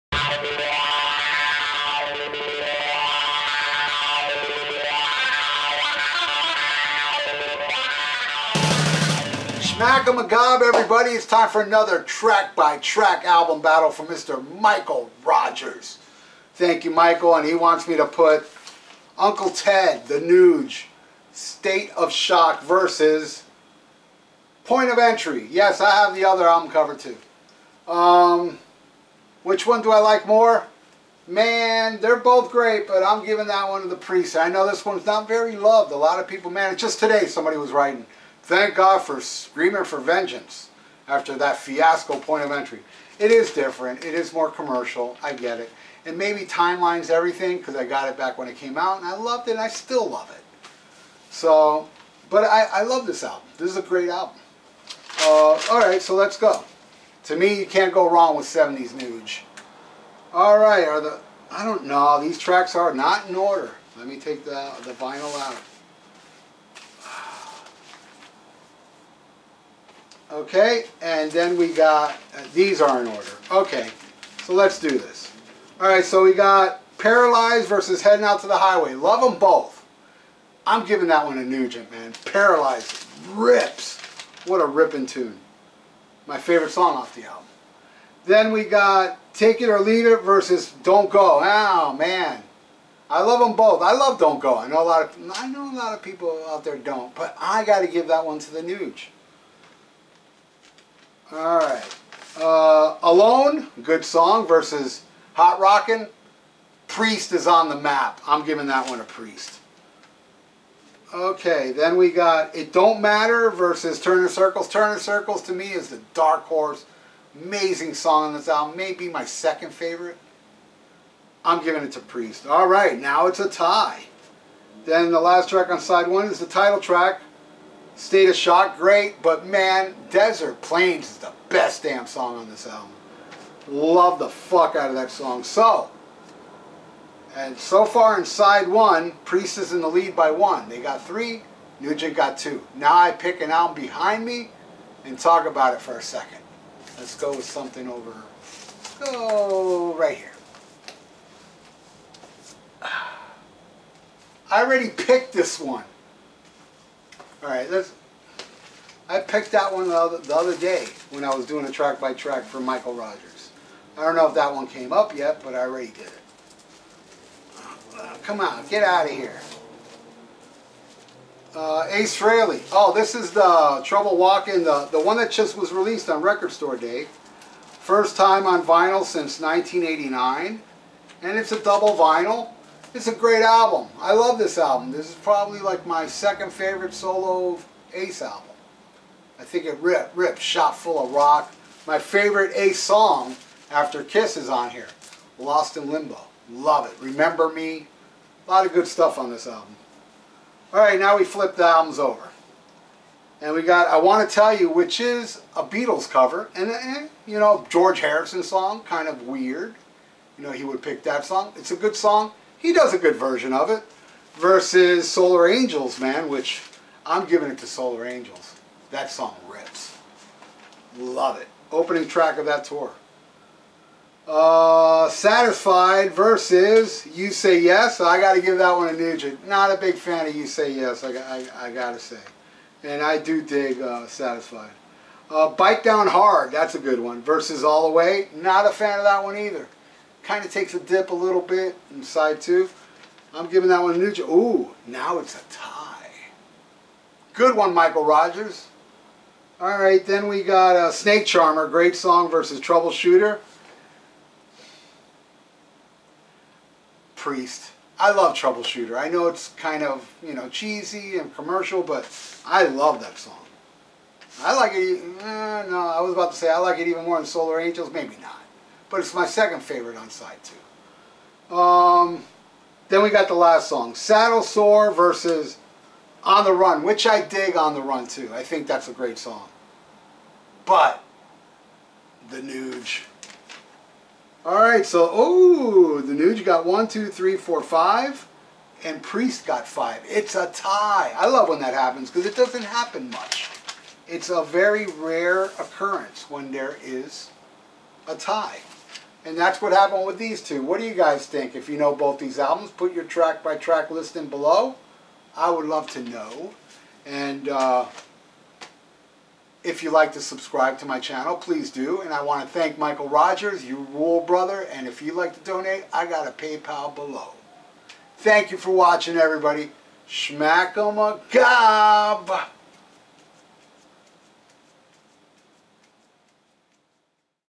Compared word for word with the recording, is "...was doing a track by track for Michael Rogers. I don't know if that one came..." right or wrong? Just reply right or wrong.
right.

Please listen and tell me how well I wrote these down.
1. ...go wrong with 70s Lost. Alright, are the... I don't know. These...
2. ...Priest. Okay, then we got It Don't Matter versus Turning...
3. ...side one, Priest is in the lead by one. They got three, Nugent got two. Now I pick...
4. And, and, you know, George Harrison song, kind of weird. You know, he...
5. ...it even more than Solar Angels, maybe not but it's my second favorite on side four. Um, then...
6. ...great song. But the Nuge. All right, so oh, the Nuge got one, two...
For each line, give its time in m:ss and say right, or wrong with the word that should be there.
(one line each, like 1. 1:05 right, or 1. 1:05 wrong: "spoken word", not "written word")
1. 0:57 wrong: "Nuge", not "Lost"
2. 1:49 right
3. 2:18 right
4. 3:26 right
5. 4:26 wrong: "two", not "four"
6. 4:38 right.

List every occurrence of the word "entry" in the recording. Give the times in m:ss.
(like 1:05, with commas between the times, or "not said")
0:24, 0:42.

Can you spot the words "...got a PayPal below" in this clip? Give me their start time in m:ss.
5:16.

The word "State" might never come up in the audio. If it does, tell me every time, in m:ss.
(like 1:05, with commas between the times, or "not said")
0:21, 2:07.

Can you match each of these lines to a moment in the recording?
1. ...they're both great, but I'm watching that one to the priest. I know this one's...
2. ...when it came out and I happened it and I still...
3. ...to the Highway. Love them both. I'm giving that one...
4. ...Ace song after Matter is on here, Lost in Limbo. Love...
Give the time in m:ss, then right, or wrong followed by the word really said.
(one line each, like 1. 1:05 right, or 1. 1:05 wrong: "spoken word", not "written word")
1. 0:32 wrong: "giving", not "watching"
2. 0:48 wrong: "loved", not "happened"
3. 1:18 right
4. 3:12 wrong: "Kiss", not "Matter".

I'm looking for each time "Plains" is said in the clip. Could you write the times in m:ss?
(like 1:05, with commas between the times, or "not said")
2:10.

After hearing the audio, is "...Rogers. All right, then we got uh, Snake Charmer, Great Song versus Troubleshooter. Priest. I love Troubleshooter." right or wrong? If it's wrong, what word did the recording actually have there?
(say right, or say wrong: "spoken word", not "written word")
right.